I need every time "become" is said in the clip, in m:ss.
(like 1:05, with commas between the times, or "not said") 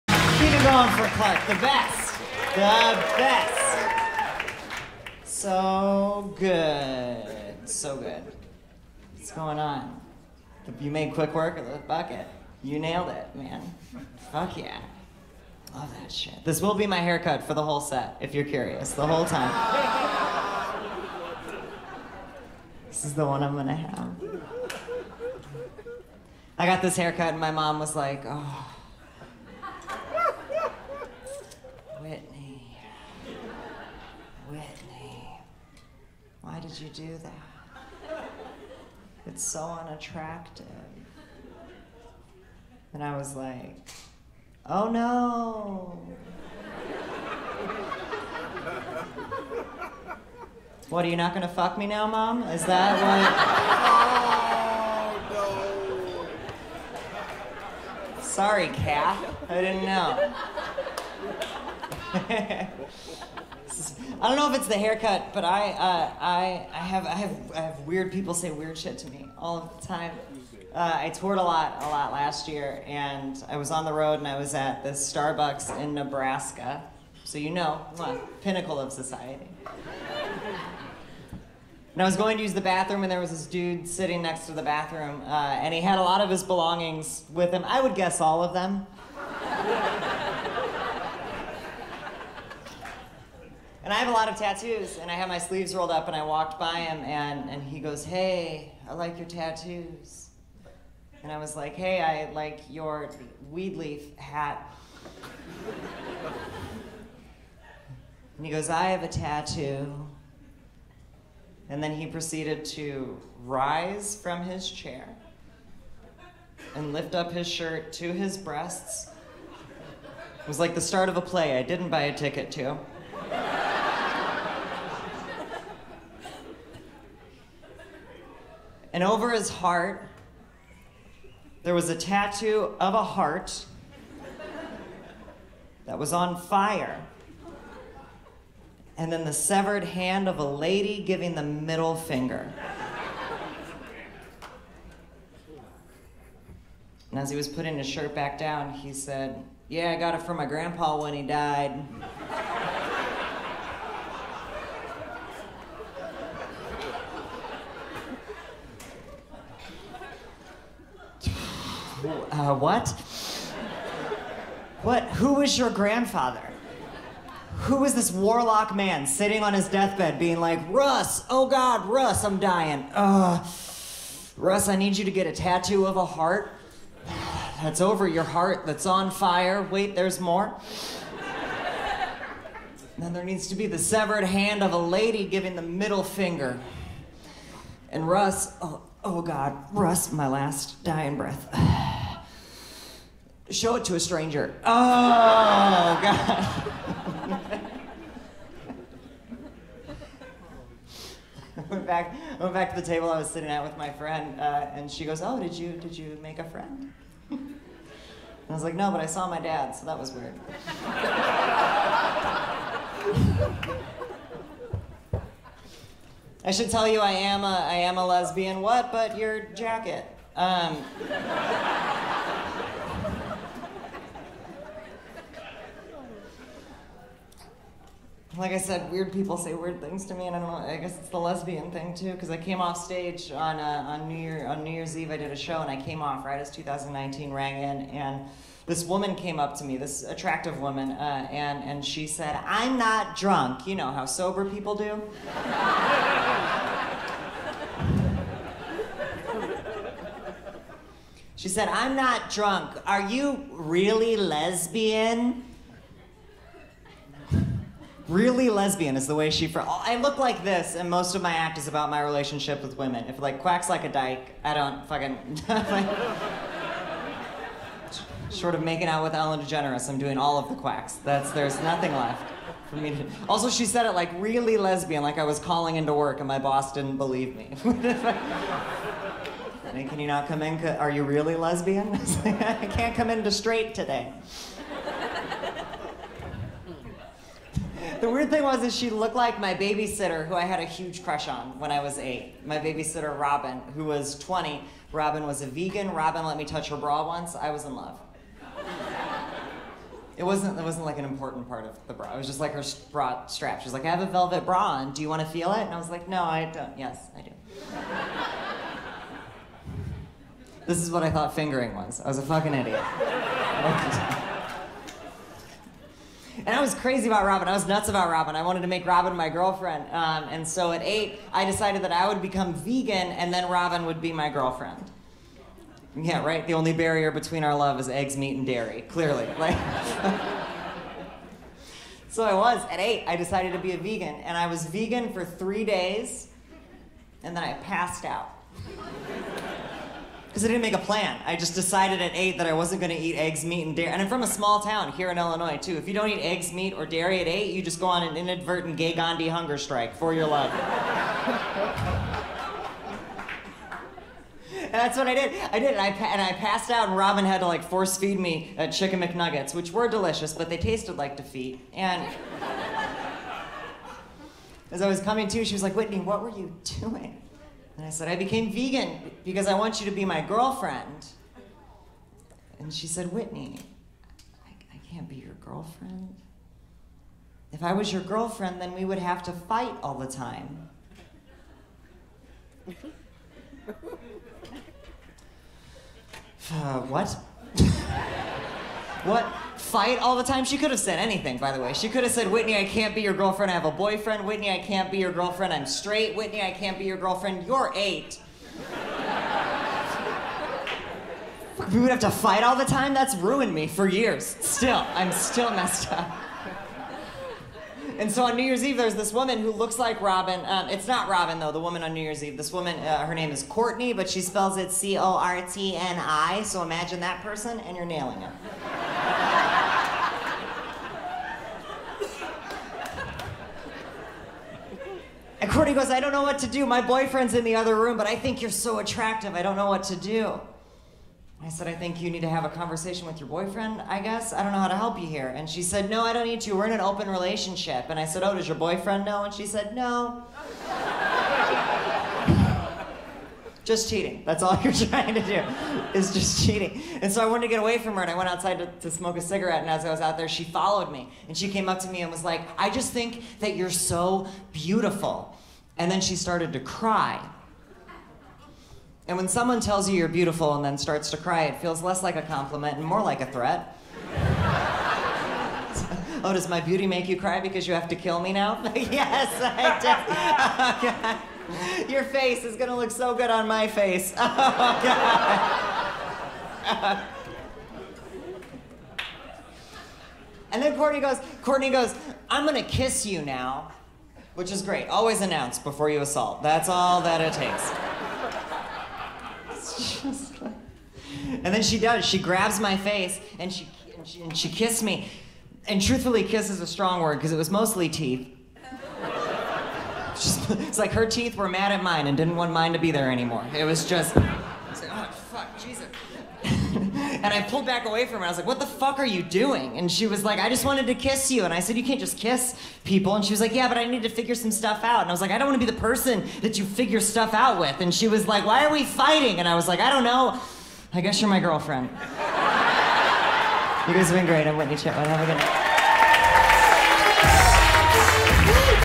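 5:22.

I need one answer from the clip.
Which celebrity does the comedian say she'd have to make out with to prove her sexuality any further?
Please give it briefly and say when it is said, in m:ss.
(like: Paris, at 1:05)
Ellen DeGeneres, at 4:29.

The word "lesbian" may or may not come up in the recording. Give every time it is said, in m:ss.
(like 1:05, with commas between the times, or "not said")
3:38, 3:51, 4:14, 4:18, 4:34, 4:41.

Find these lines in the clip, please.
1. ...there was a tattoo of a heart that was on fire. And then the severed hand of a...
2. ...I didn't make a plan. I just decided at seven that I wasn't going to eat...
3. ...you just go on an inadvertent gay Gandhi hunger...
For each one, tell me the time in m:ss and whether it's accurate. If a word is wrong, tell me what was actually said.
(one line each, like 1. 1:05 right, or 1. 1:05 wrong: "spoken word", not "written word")
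1. 2:11 right
2. 5:40 wrong: "eight", not "seven"
3. 5:47 right.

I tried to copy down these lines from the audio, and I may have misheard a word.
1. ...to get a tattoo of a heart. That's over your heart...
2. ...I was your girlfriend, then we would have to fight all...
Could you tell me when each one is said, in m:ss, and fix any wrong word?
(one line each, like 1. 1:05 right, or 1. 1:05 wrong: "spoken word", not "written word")
1. 2:55 right
2. 6:17 right.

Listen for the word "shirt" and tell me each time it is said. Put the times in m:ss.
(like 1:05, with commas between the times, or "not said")
1:57, 2:27.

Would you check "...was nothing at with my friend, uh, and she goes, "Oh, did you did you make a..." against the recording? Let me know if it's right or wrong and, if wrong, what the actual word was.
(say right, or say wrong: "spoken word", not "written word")
wrong: "sitting", not "nothing".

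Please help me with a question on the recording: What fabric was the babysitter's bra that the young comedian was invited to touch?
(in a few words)
Velvet.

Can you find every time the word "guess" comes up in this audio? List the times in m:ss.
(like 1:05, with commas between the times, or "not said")
1:27, 3:50, 7:13, 8:41.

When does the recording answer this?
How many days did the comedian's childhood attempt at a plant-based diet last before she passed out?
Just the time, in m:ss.
5:35.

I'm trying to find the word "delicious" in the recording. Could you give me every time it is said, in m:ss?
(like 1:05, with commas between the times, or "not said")
5:59.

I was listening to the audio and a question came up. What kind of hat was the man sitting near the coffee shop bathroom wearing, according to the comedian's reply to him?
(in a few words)
Weed leaf hat.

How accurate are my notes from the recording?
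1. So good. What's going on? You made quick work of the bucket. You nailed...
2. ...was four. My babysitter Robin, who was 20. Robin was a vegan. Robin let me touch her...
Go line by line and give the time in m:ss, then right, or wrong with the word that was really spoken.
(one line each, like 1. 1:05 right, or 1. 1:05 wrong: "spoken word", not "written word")
1. 0:07 right
2. 4:51 wrong: "eight", not "four".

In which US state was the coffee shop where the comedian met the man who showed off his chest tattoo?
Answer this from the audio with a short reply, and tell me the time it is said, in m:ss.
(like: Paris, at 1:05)
Nebraska, at 1:15.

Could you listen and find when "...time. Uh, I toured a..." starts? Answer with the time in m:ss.
1:09.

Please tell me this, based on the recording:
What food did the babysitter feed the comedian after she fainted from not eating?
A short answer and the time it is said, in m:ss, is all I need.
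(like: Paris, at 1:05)
Chicken McNuggets, at 5:58.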